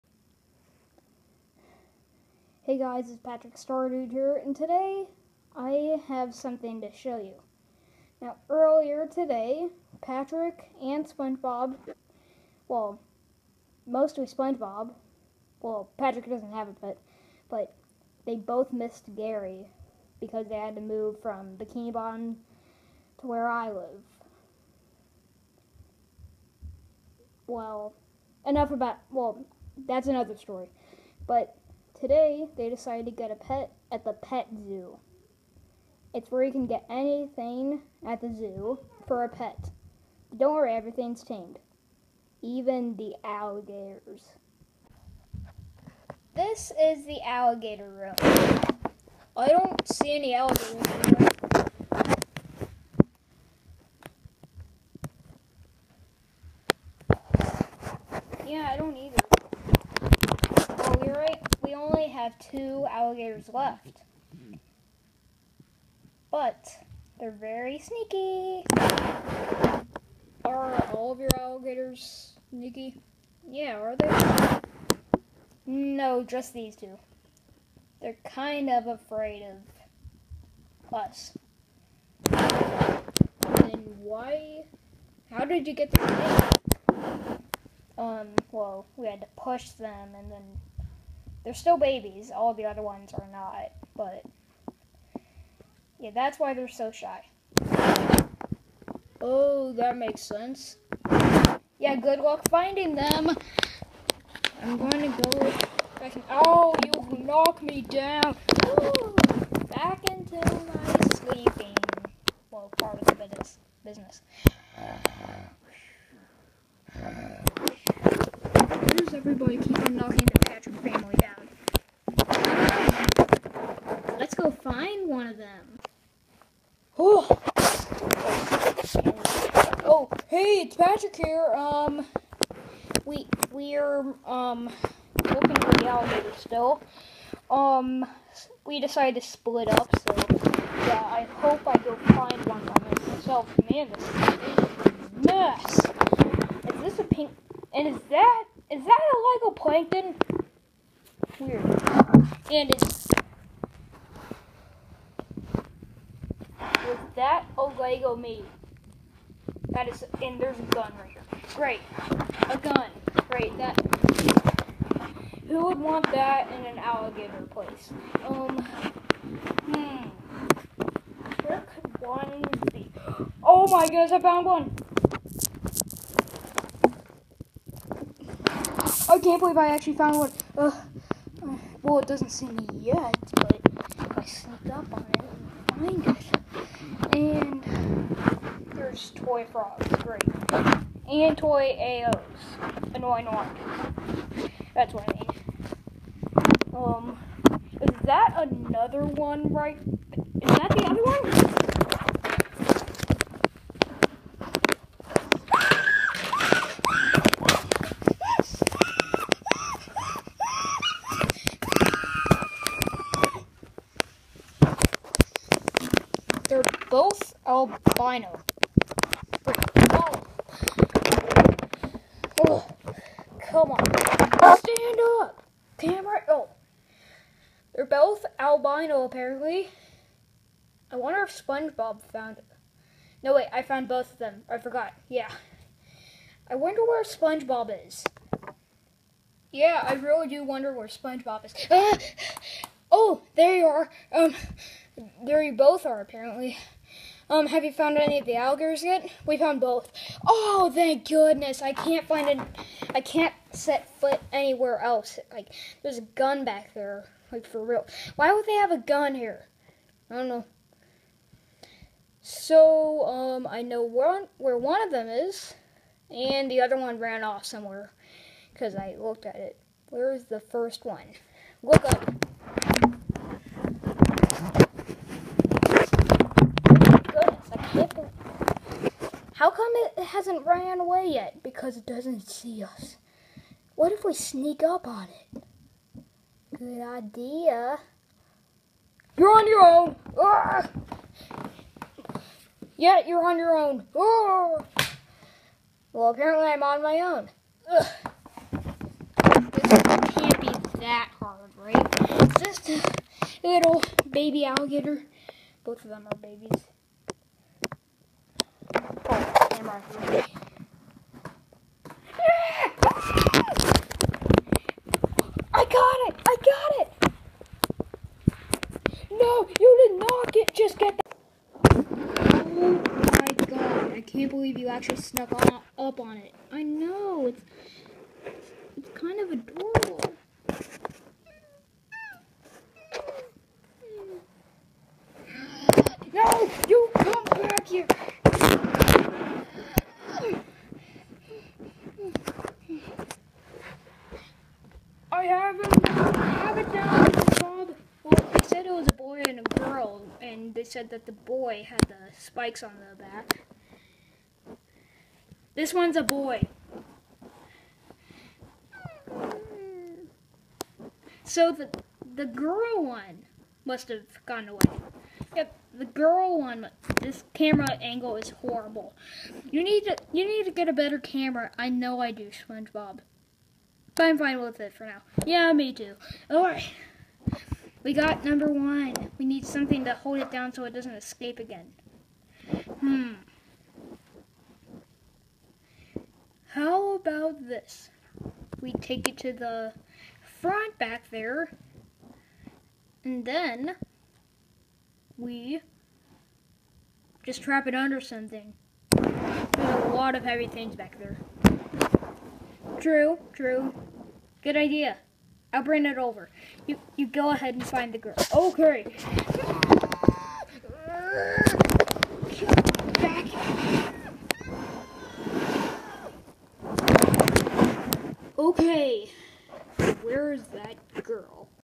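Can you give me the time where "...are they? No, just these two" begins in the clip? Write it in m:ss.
1:13.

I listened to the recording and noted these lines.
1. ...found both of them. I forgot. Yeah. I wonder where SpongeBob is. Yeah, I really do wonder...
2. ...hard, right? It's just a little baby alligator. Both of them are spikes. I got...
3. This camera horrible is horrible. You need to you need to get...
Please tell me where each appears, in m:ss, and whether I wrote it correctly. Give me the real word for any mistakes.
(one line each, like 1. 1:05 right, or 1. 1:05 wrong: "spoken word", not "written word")
1. 3:53 right
2. 5:01 wrong: "babies", not "spikes"
3. 6:06 wrong: "angle", not "horrible".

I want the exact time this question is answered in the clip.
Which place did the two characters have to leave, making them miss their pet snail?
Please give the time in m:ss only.
0:21.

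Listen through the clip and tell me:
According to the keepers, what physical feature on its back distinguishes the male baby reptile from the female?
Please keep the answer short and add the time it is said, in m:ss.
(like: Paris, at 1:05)
spikes, at 5:52.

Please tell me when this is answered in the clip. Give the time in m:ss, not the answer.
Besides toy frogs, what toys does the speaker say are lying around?
3:11.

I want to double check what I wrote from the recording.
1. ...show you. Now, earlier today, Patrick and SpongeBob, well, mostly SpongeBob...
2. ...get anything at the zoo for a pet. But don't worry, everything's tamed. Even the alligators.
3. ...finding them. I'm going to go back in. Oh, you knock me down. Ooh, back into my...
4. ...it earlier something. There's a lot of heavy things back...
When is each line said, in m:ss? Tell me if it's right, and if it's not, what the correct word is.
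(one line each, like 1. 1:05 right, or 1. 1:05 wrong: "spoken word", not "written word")
1. 0:06 right
2. 0:36 right
3. 1:42 right
4. 6:37 wrong: "under", not "earlier".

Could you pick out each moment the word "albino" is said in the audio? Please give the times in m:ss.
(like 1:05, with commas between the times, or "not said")
3:37, 3:48.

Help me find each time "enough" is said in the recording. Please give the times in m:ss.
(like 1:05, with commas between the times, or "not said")
0:28.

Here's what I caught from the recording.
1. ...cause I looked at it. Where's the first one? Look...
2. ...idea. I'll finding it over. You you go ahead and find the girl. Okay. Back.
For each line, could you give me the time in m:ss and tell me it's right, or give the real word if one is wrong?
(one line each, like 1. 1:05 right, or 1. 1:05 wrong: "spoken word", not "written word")
1. 4:28 right
2. 6:44 wrong: "bring", not "finding".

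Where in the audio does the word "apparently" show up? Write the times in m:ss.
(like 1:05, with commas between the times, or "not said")
3:49, 4:06, 4:56.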